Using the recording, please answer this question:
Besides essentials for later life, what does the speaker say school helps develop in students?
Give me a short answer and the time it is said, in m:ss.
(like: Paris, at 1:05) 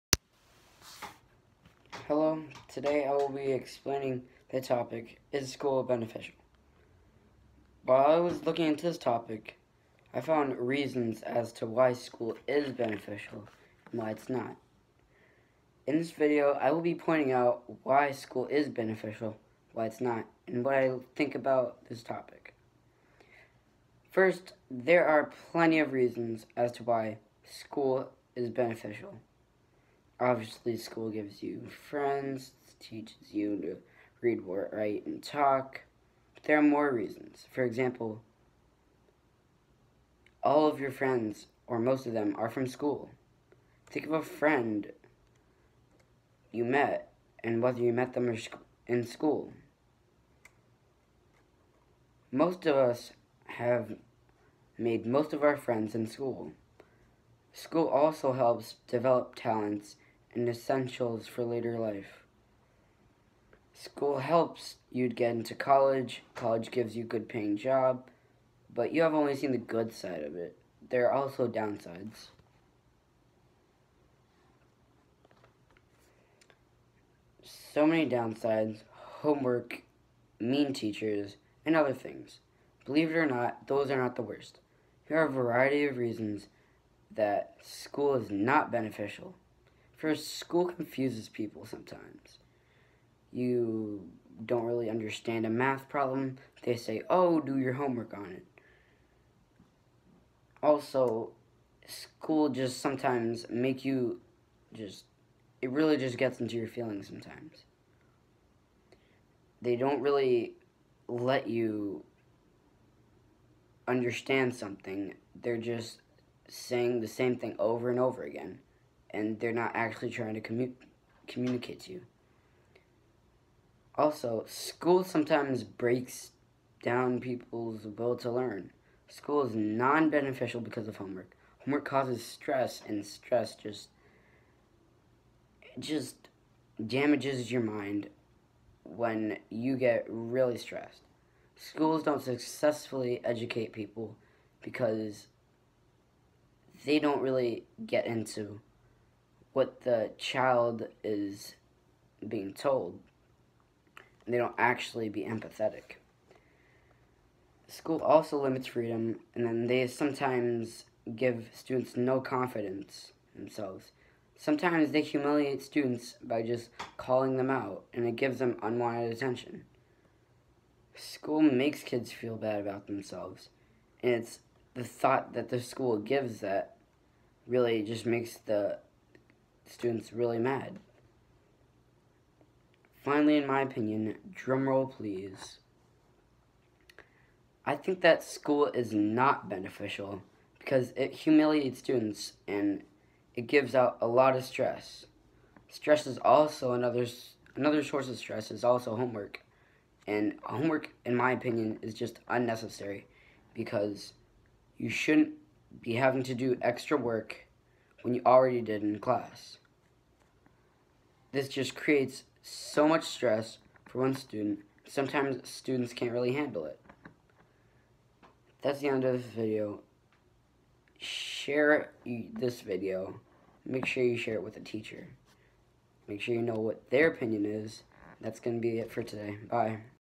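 talents, at 0:59.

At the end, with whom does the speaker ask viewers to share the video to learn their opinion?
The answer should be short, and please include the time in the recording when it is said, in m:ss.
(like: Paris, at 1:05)
a teacher, at 3:44.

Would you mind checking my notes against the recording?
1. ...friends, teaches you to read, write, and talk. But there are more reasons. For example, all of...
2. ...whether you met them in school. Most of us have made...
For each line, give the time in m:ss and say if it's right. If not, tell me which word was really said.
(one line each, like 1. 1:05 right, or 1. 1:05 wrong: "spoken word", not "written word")
1. 0:31 right
2. 0:47 right.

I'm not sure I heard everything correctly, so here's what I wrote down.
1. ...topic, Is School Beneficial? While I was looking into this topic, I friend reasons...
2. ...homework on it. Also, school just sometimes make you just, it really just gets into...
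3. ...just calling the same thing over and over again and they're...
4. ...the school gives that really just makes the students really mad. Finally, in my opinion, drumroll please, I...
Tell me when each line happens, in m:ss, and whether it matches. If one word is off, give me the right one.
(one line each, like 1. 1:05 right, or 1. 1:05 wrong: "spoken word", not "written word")
1. 0:04 wrong: "found", not "friend"
2. 1:37 right
3. 1:55 wrong: "saying", not "calling"
4. 2:55 right.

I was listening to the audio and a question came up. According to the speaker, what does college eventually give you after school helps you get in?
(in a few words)
a good paying job.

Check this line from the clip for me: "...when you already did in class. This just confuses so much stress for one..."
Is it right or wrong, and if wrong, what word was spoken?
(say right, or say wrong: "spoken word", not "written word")
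wrong: "creates", not "confuses".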